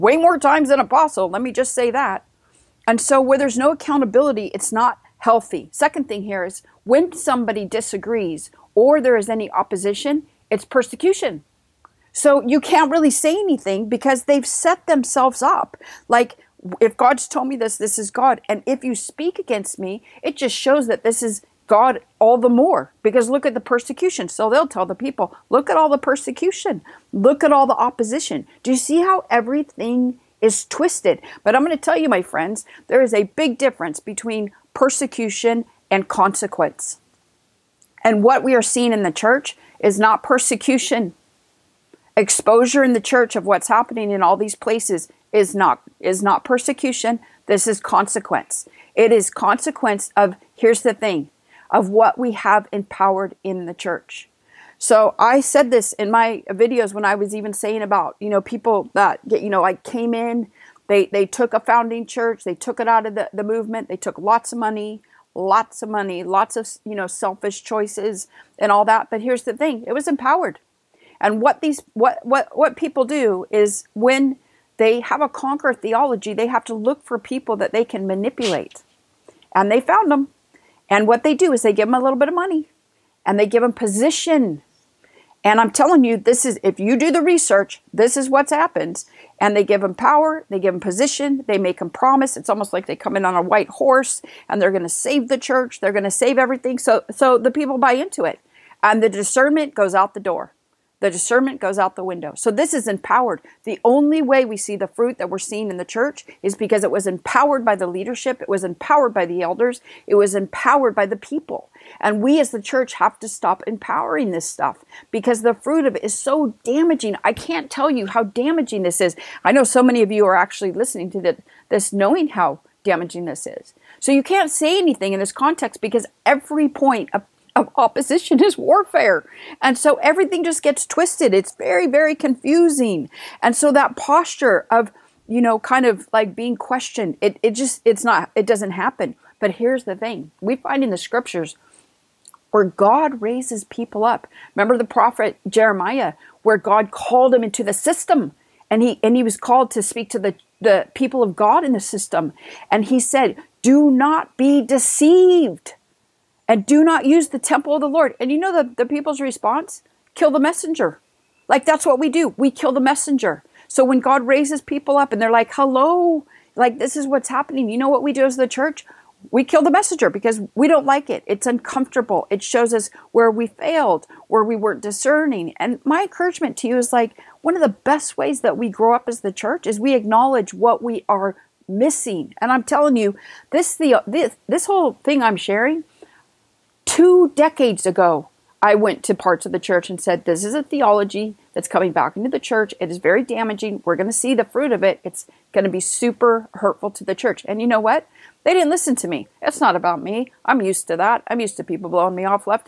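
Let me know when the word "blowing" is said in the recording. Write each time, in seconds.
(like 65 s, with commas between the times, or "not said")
201 s.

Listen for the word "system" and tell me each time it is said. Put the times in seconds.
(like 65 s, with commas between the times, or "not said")
147 s, 151 s.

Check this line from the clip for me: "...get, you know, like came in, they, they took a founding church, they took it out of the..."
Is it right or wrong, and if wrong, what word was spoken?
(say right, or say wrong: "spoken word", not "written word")
right.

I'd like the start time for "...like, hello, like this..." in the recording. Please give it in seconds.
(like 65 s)
165 s.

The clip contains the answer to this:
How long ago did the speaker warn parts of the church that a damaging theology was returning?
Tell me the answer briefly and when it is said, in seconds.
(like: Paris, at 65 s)
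Two decades, at 186 s.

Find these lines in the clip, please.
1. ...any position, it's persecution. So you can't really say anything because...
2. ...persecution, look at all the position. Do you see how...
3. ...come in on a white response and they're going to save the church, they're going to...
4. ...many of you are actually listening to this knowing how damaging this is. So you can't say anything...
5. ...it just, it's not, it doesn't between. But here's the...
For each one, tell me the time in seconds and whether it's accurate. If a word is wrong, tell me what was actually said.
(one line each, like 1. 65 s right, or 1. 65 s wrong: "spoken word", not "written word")
1. 9 s wrong: "opposition", not "position"
2. 25 s wrong: "opposition", not "position"
3. 92 s wrong: "horse", not "response"
4. 119 s right
5. 137 s wrong: "happen", not "between".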